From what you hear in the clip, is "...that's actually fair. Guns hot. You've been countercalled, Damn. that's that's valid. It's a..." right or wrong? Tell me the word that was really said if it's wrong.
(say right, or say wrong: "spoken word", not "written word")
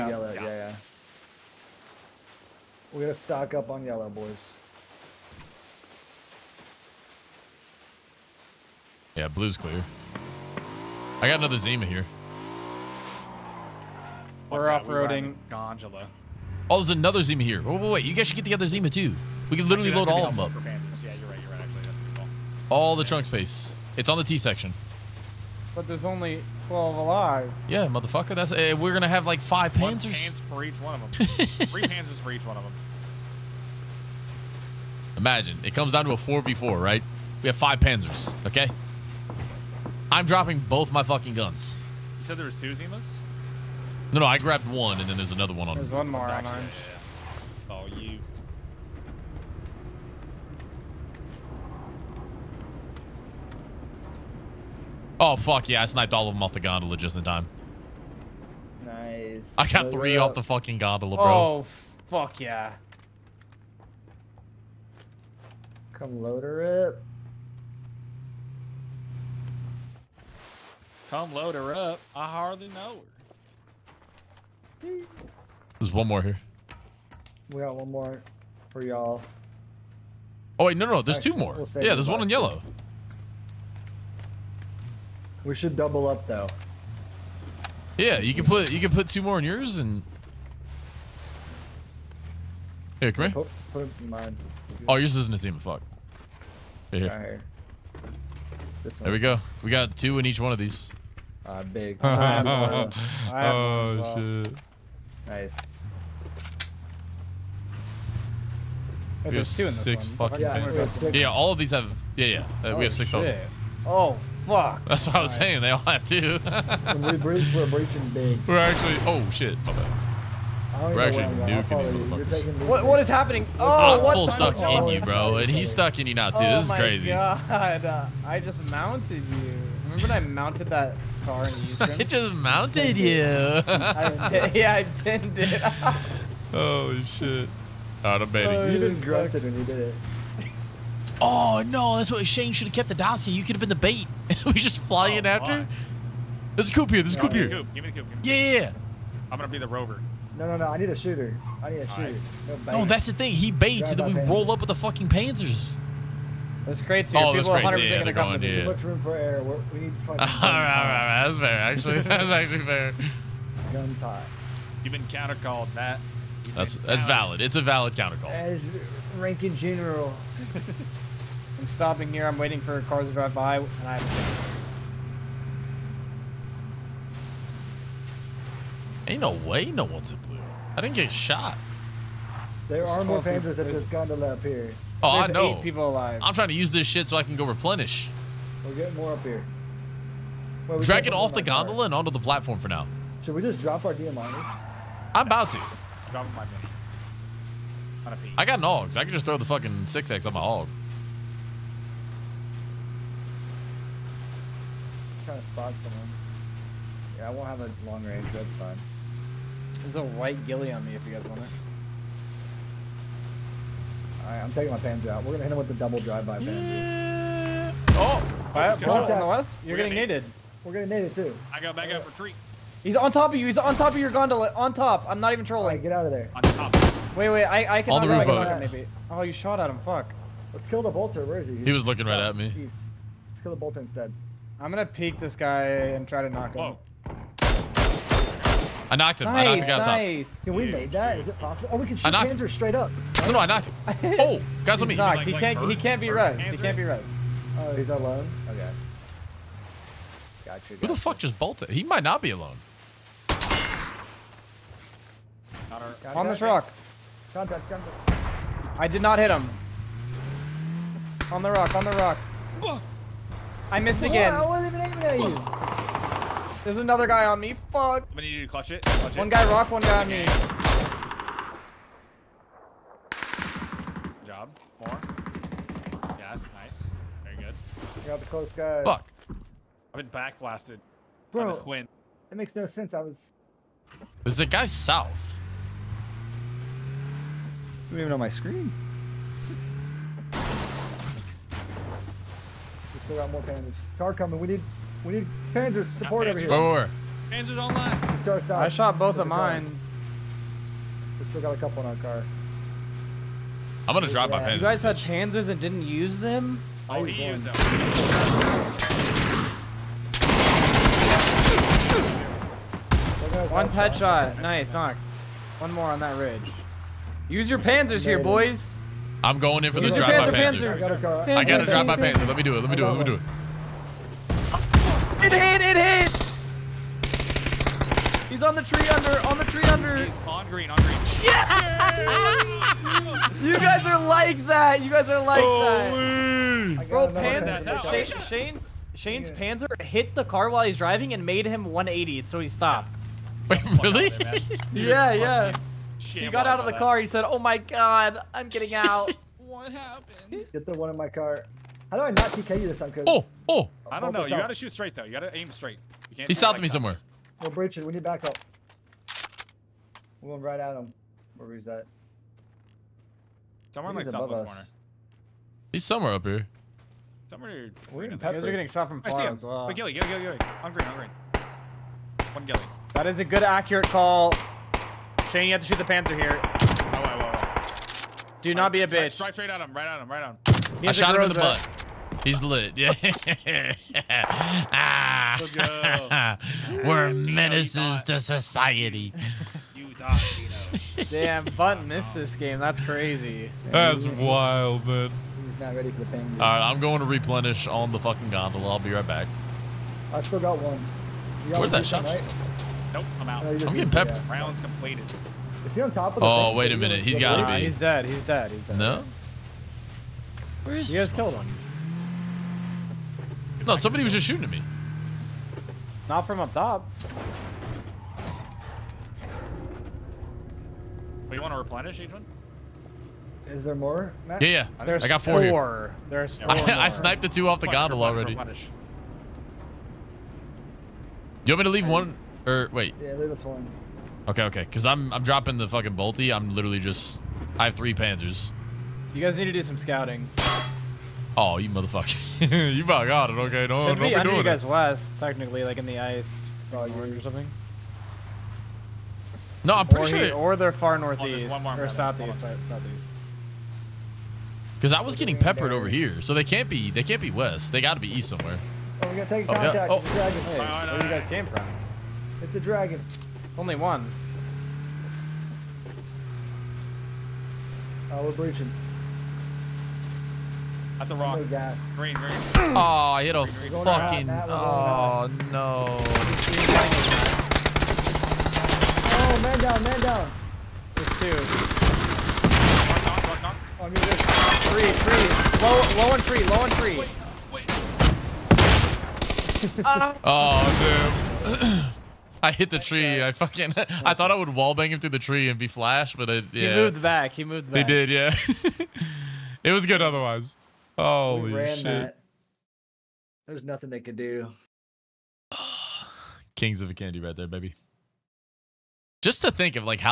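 wrong: "Matt", not "Damn".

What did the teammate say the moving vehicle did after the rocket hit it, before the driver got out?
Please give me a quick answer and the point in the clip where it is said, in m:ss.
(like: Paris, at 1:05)
180, at 5:41.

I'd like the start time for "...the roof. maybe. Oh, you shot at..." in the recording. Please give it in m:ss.
3:48.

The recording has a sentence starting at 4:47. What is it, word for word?
I don't even know my screen.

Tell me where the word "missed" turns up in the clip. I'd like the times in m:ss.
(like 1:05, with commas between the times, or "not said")
4:23, 6:31.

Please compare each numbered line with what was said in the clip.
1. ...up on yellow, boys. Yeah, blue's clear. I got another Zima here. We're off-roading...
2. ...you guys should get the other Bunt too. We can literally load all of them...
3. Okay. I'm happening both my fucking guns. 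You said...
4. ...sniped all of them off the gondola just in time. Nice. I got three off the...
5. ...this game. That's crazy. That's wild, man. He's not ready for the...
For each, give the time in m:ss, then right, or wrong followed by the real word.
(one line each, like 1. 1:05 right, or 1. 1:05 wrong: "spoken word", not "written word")
1. 0:03 right
2. 0:18 wrong: "Zima", not "Bunt"
3. 0:38 wrong: "dropping", not "happening"
4. 0:55 right
5. 6:32 right.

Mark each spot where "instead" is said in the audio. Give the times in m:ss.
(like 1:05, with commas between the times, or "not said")
3:53.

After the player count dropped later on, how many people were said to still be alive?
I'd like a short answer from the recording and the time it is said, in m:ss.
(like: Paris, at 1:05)
Eight, at 3:05.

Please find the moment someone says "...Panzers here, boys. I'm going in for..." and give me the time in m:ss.
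5:17.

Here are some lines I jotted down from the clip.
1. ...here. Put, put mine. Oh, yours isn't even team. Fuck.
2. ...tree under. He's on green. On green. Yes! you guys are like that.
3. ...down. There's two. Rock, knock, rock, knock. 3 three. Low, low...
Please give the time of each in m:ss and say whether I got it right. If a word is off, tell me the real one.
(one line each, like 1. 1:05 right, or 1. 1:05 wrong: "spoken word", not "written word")
1. 1:33 right
2. 5:29 right
3. 8:00 right.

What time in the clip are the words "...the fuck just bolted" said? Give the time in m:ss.
4:10.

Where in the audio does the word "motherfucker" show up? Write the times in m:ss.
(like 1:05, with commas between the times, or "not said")
0:27, 2:02, 7:21.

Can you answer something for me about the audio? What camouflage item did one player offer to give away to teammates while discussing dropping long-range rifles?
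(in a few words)
White gilly.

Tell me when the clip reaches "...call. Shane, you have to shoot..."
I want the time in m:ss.
6:13.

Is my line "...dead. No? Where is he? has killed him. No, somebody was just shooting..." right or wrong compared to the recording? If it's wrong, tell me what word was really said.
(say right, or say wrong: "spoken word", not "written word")
right.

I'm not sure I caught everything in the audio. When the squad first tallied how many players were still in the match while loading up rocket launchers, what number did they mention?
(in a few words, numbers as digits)
12.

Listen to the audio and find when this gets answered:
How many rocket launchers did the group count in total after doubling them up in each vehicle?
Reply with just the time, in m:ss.
1:52.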